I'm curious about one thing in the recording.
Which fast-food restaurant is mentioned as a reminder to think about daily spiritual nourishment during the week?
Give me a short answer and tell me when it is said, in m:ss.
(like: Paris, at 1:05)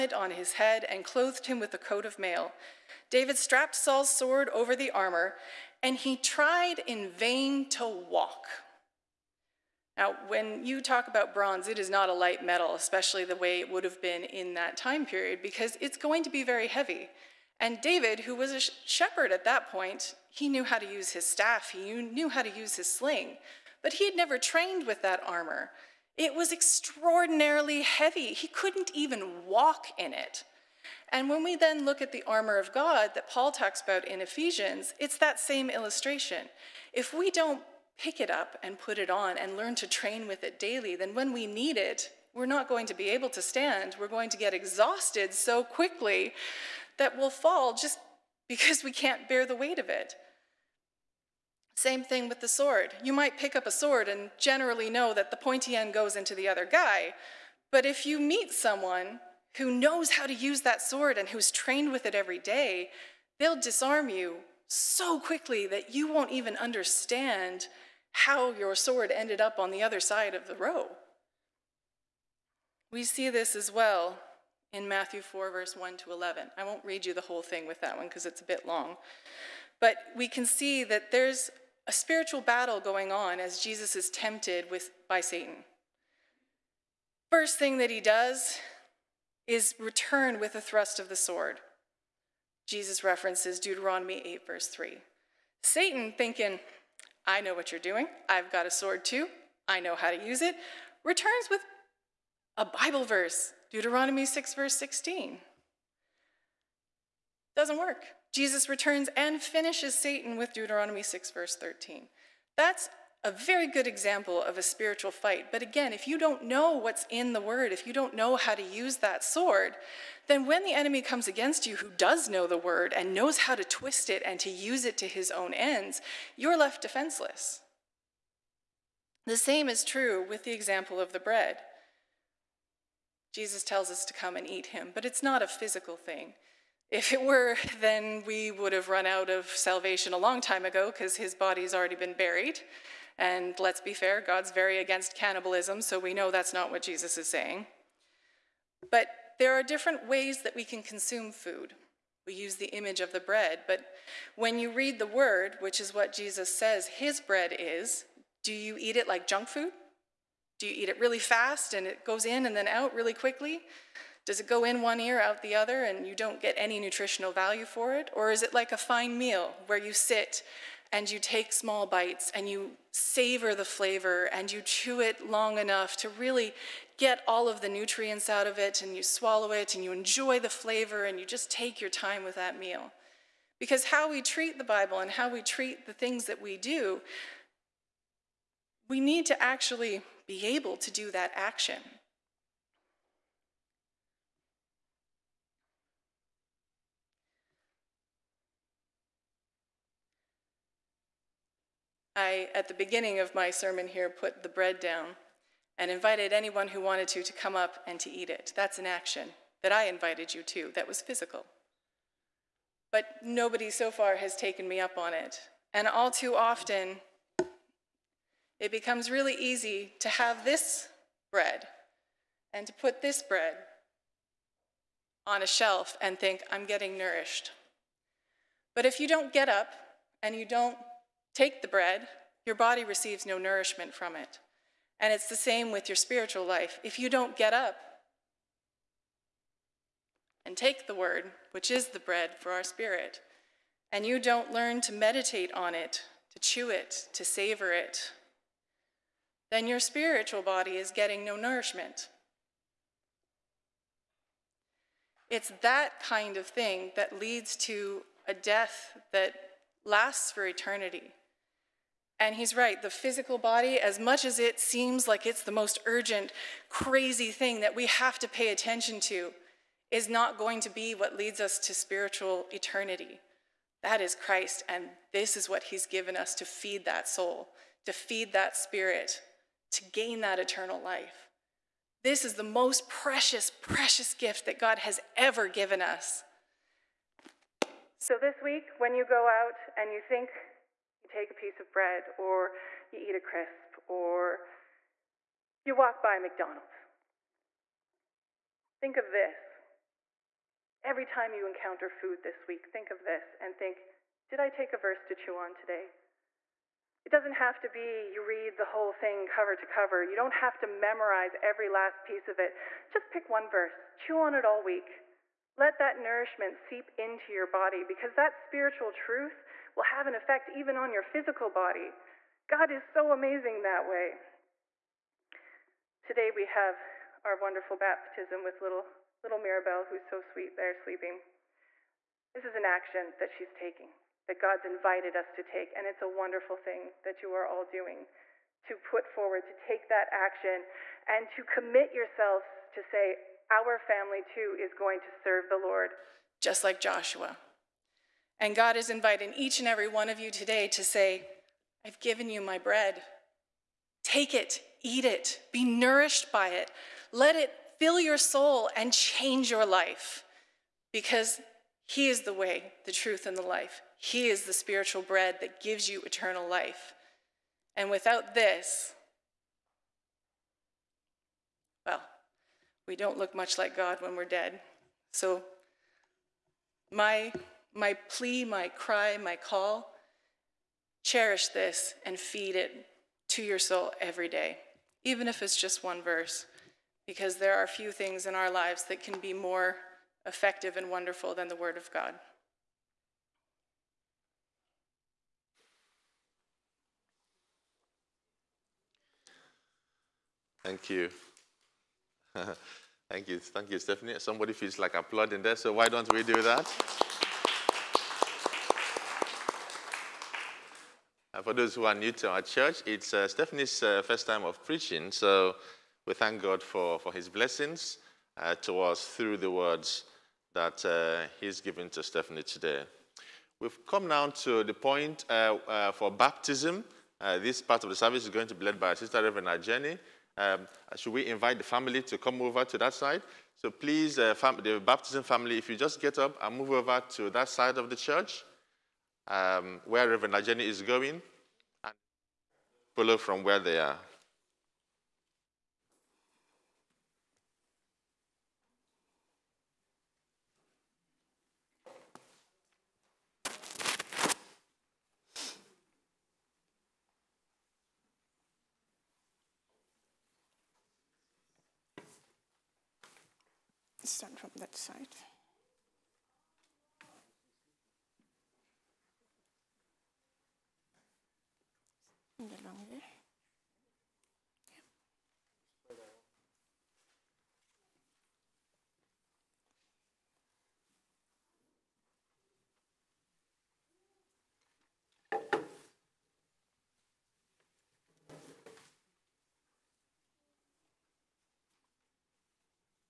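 McDonald's, at 4:56.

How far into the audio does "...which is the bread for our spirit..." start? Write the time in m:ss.
4:01.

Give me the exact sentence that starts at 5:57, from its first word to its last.
Let it fill your soul and change your life because He is the way, the truth, and the life.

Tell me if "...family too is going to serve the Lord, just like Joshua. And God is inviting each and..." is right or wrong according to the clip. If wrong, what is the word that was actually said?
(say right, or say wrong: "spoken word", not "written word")
right.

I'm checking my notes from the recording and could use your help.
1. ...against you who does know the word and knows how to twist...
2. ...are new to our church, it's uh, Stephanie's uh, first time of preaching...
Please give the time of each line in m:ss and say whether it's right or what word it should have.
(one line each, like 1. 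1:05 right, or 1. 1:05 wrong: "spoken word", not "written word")
1. 2:01 right
2. 6:51 right.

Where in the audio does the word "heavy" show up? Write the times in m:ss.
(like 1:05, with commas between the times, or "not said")
0:16, 0:27.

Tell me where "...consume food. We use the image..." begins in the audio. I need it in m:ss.
2:30.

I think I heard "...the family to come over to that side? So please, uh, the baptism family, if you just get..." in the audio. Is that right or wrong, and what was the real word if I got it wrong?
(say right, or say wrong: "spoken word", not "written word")
right.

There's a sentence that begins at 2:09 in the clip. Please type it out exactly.
The same is true with the example of the bread.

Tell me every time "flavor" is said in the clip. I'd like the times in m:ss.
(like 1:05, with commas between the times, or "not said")
2:53, 3:00.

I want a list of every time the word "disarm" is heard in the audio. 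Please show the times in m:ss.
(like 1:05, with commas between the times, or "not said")
1:03.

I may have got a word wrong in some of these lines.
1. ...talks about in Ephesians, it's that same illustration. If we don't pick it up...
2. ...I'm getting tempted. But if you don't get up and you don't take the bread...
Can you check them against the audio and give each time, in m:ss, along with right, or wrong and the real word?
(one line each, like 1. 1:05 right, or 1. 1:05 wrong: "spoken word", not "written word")
1. 0:33 right
2. 3:46 wrong: "nourished", not "tempted".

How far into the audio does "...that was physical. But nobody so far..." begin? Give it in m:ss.
3:30.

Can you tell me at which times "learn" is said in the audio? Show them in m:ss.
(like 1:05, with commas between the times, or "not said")
0:39, 4:04.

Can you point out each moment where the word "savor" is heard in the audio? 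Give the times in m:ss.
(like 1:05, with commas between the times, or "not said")
2:52, 4:07.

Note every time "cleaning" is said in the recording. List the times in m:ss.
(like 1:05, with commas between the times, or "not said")
not said.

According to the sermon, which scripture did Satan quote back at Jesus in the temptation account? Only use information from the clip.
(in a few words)
Deuteronomy 6:16.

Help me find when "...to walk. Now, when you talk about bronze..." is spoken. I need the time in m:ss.
0:07.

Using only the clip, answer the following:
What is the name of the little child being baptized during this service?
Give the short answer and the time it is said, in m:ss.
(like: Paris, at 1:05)
Mirabelle, at 5:29.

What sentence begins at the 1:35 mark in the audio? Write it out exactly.
Satan, thinking, I know what you're doing.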